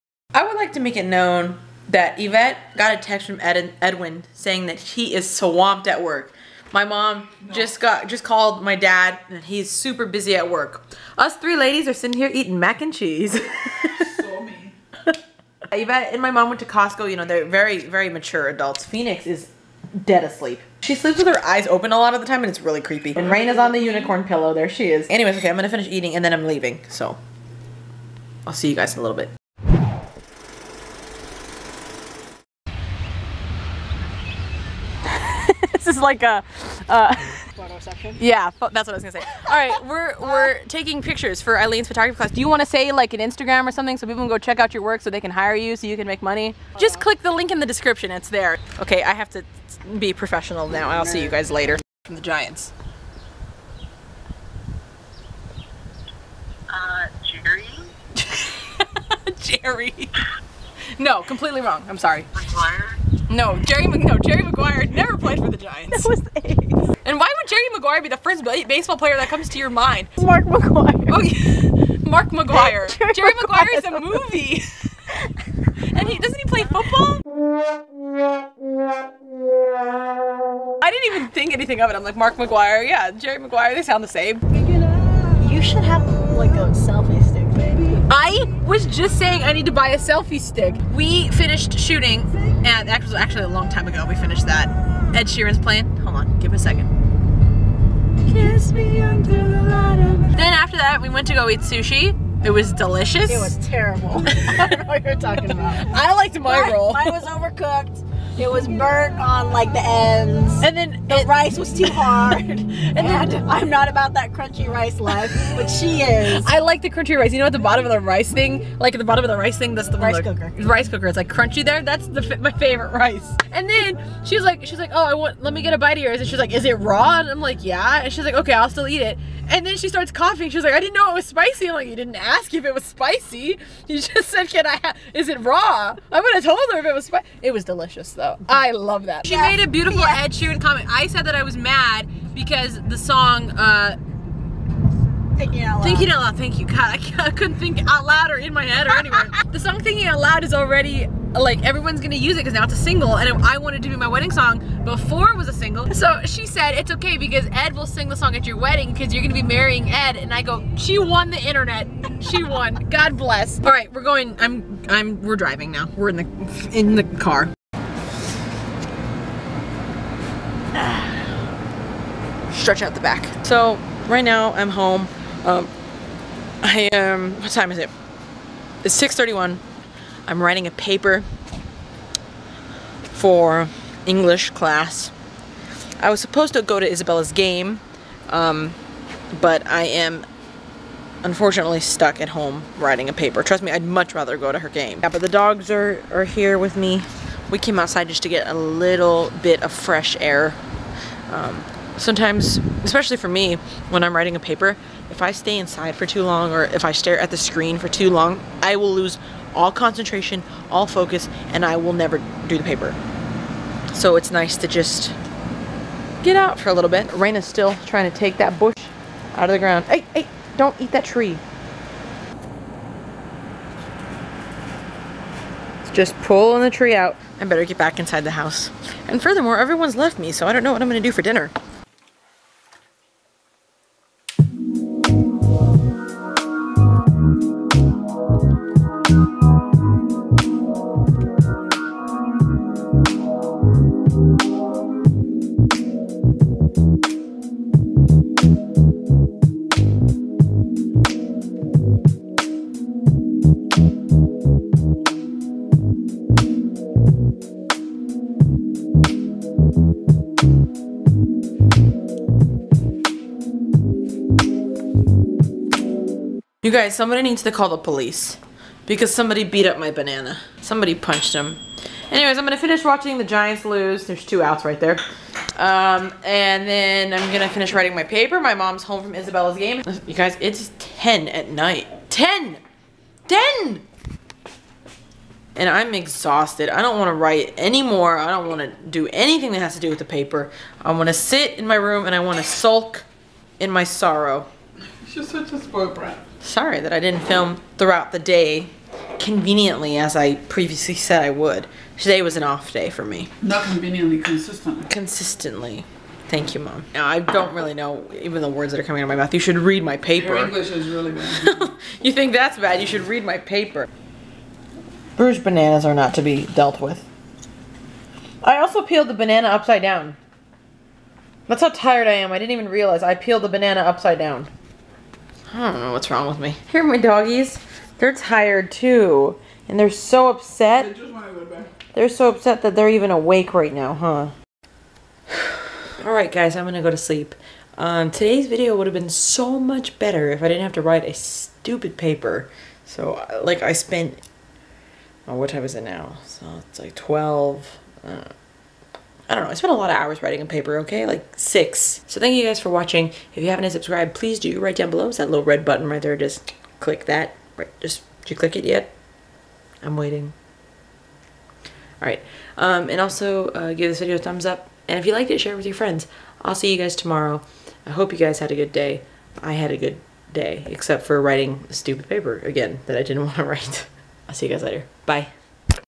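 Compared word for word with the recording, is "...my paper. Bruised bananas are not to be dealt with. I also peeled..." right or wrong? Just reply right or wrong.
right.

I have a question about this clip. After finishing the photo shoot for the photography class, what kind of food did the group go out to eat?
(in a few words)
sushi.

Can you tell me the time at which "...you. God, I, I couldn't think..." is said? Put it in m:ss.
2:26.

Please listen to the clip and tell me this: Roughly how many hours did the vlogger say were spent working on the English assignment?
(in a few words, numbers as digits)
6.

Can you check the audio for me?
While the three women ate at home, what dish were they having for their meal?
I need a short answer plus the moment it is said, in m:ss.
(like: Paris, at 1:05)
mac and cheese, at 0:12.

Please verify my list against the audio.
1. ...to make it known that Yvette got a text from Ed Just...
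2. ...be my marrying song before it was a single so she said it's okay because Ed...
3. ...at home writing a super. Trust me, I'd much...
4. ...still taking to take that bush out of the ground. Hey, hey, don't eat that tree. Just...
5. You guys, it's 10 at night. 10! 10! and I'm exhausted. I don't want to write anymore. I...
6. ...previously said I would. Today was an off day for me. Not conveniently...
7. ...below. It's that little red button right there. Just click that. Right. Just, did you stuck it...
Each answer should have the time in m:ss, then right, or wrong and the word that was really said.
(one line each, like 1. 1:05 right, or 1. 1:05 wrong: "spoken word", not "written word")
1. 0:00 wrong: "Edwin", not "Just"
2. 2:33 wrong: "wedding", not "marrying"
3. 3:12 wrong: "paper", not "super"
4. 3:37 wrong: "trying", not "taking"
5. 4:40 right
6. 5:00 right
7. 5:54 wrong: "click", not "stuck".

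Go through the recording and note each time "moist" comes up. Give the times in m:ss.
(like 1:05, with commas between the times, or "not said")
not said.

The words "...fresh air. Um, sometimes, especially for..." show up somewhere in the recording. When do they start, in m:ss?
3:19.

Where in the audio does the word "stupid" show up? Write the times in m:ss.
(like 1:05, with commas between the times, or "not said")
5:41, 6:11.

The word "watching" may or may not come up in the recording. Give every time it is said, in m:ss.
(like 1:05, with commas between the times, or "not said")
4:32, 5:52.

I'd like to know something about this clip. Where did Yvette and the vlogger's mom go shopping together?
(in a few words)
Costco.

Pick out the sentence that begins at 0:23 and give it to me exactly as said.
And Rain is on the unicorn pillow.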